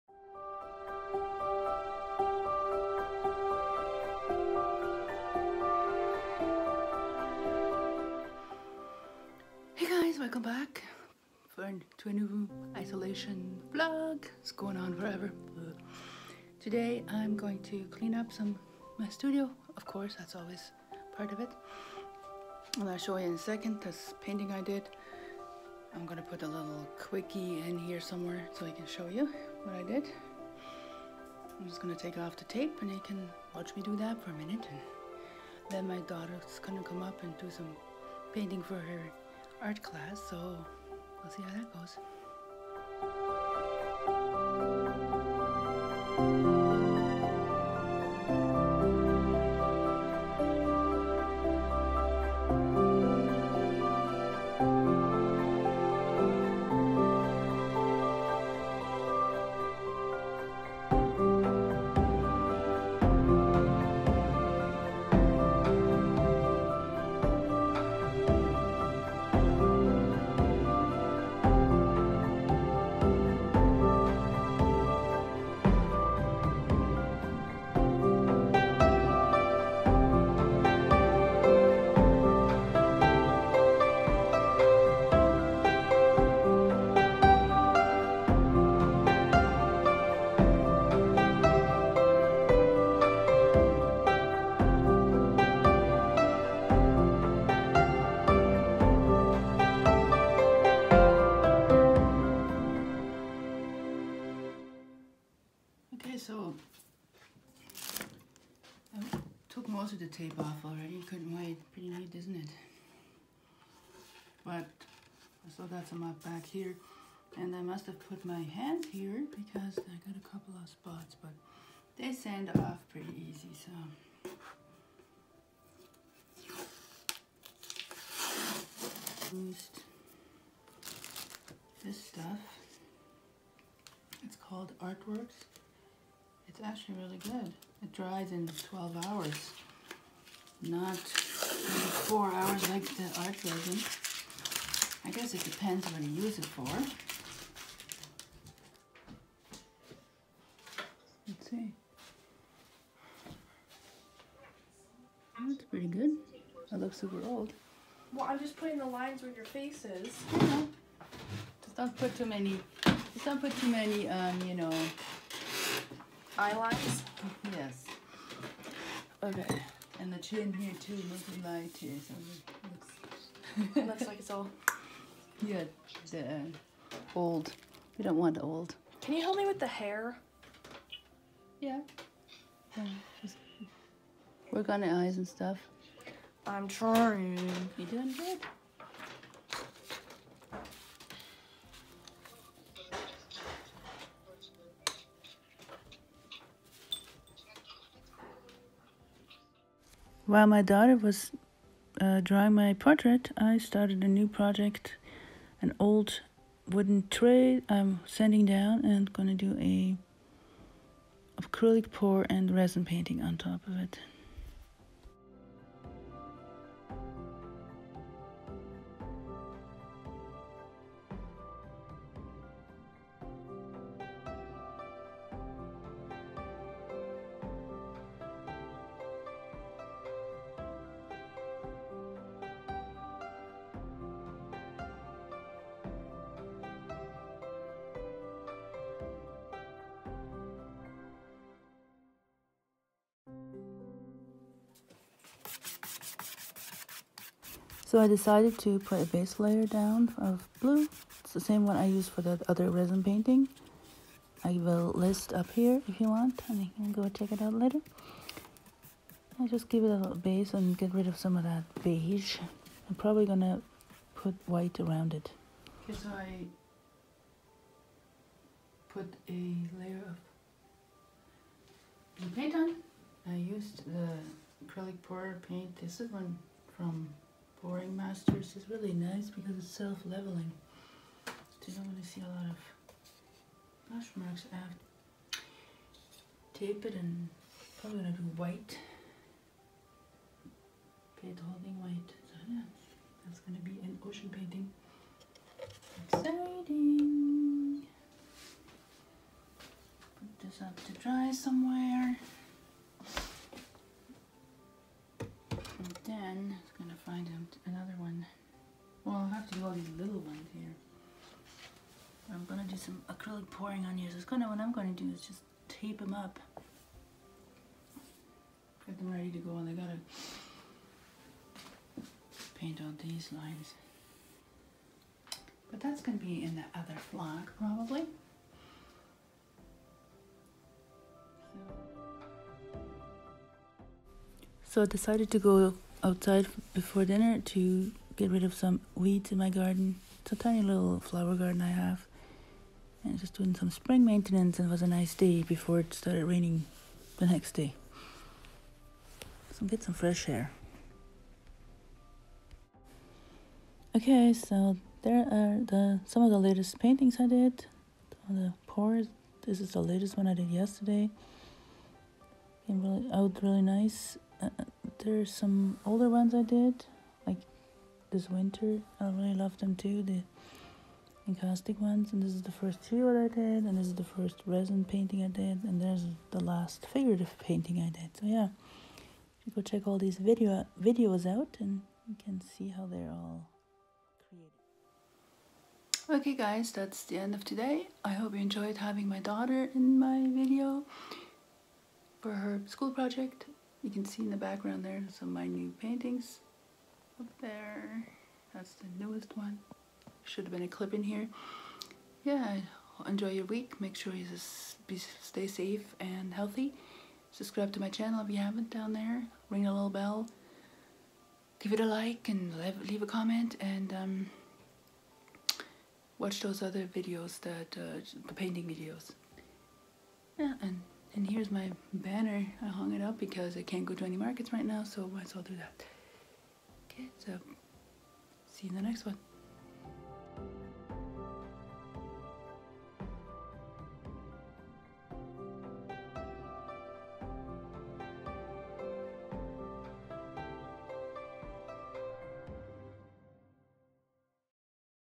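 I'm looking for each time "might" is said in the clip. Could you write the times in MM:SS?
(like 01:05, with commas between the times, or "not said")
07:05.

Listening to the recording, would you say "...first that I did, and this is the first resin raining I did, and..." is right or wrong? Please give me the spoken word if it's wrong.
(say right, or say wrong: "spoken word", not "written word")
wrong: "painting", not "raining".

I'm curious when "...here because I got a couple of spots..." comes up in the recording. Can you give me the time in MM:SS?
01:58.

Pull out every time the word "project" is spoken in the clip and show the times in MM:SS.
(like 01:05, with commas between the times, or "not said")
03:24, 06:32.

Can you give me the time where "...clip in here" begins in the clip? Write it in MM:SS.
06:40.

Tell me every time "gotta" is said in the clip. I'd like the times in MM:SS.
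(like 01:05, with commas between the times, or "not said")
05:19.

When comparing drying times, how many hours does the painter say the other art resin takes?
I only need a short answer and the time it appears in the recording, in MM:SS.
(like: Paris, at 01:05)
4, at 02:20.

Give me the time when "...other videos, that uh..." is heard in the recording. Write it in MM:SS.
06:56.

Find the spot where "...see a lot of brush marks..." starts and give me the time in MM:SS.
04:42.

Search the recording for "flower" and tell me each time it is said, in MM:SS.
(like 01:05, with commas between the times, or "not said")
05:40.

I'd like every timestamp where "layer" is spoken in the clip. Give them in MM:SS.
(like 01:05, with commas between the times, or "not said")
04:09, 04:29.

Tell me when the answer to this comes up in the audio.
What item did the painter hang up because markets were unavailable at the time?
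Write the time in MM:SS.
07:01.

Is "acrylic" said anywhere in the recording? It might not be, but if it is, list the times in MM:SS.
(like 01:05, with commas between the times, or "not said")
03:31, 04:34, 05:13.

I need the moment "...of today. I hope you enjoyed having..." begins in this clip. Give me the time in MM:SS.
06:27.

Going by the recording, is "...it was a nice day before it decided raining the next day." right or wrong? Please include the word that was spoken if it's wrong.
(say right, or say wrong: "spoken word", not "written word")
wrong: "started", not "decided".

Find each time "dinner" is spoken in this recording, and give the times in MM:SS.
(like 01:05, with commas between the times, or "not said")
05:37.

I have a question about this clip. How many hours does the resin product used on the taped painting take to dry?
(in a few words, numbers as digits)
12.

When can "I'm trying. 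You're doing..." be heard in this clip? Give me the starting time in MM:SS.
03:06.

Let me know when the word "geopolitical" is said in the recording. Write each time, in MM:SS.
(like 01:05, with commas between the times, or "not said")
not said.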